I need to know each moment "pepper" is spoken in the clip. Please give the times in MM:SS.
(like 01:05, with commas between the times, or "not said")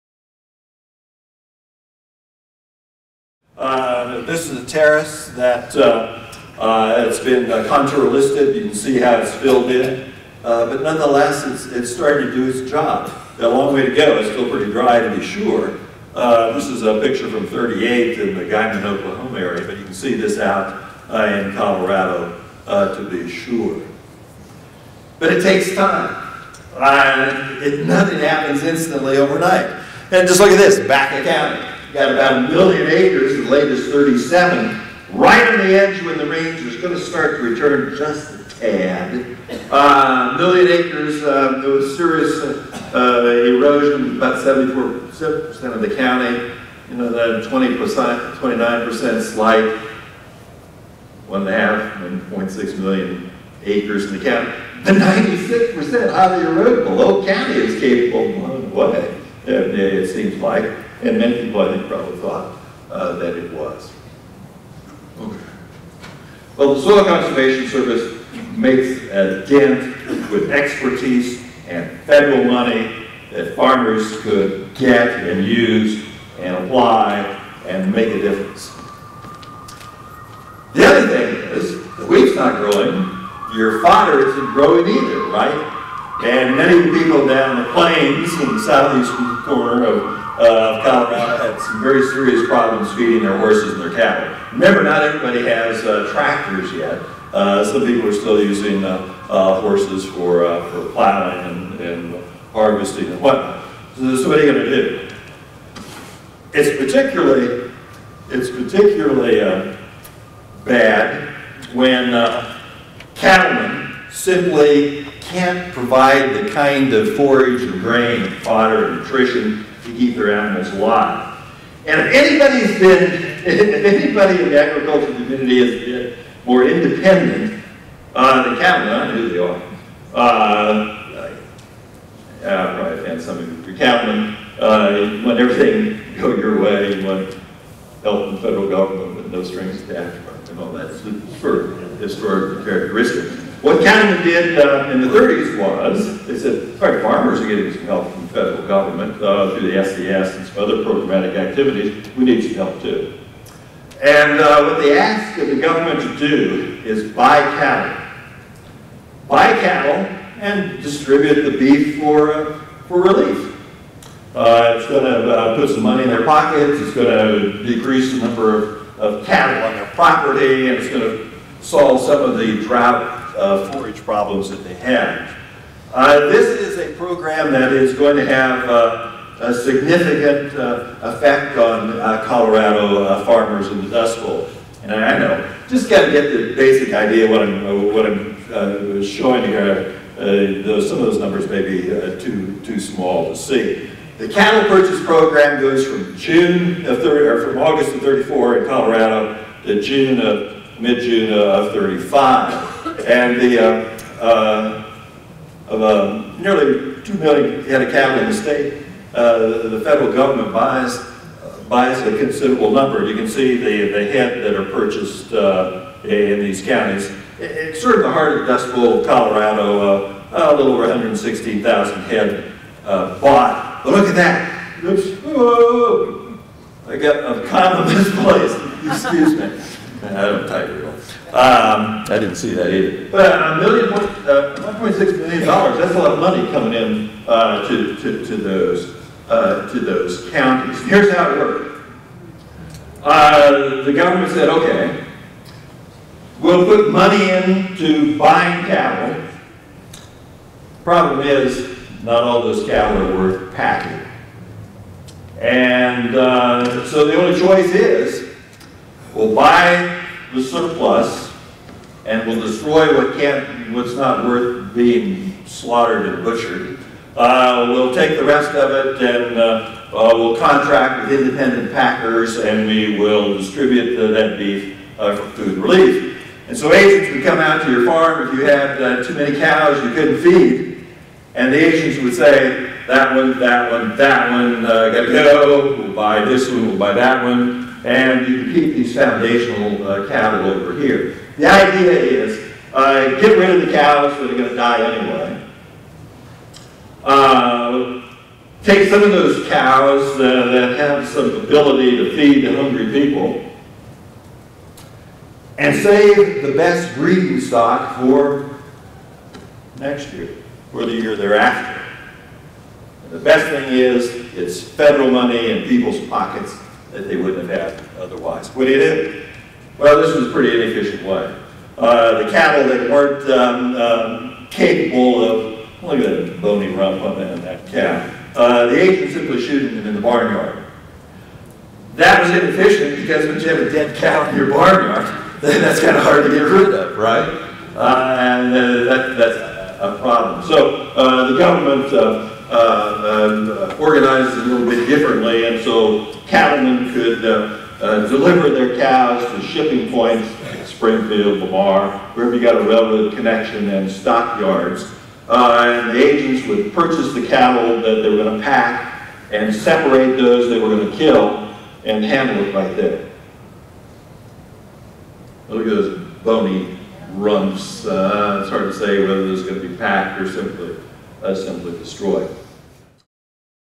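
not said.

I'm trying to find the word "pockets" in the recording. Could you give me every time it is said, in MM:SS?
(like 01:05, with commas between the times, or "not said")
02:46, 05:16.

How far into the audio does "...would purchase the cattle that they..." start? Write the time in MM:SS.
05:56.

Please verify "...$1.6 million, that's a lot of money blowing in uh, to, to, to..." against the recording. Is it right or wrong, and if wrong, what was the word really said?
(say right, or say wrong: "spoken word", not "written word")
wrong: "coming", not "blowing".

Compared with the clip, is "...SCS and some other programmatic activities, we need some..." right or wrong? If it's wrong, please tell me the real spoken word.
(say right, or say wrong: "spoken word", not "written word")
right.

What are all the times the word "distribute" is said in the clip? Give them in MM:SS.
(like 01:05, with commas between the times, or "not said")
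02:40, 04:33.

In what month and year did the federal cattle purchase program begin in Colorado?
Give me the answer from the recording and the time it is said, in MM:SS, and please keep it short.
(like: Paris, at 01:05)
August 1934, at 03:17.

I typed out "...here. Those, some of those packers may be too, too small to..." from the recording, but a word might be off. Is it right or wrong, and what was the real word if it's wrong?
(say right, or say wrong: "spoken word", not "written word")
wrong: "numbers", not "packers".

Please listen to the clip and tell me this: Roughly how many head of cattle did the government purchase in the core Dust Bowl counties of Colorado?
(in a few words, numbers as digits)
116,000.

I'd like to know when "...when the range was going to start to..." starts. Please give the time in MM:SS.
00:36.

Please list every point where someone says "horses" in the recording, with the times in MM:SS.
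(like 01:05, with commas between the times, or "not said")
01:33, 01:39.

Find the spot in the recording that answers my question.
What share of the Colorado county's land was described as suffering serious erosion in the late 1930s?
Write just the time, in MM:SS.
00:44.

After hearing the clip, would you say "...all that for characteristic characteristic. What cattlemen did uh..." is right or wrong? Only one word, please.
wrong.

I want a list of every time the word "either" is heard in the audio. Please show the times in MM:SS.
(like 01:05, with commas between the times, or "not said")
01:24, 03:52.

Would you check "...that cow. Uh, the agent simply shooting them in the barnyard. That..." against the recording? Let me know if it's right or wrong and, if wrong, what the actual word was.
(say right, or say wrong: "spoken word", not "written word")
right.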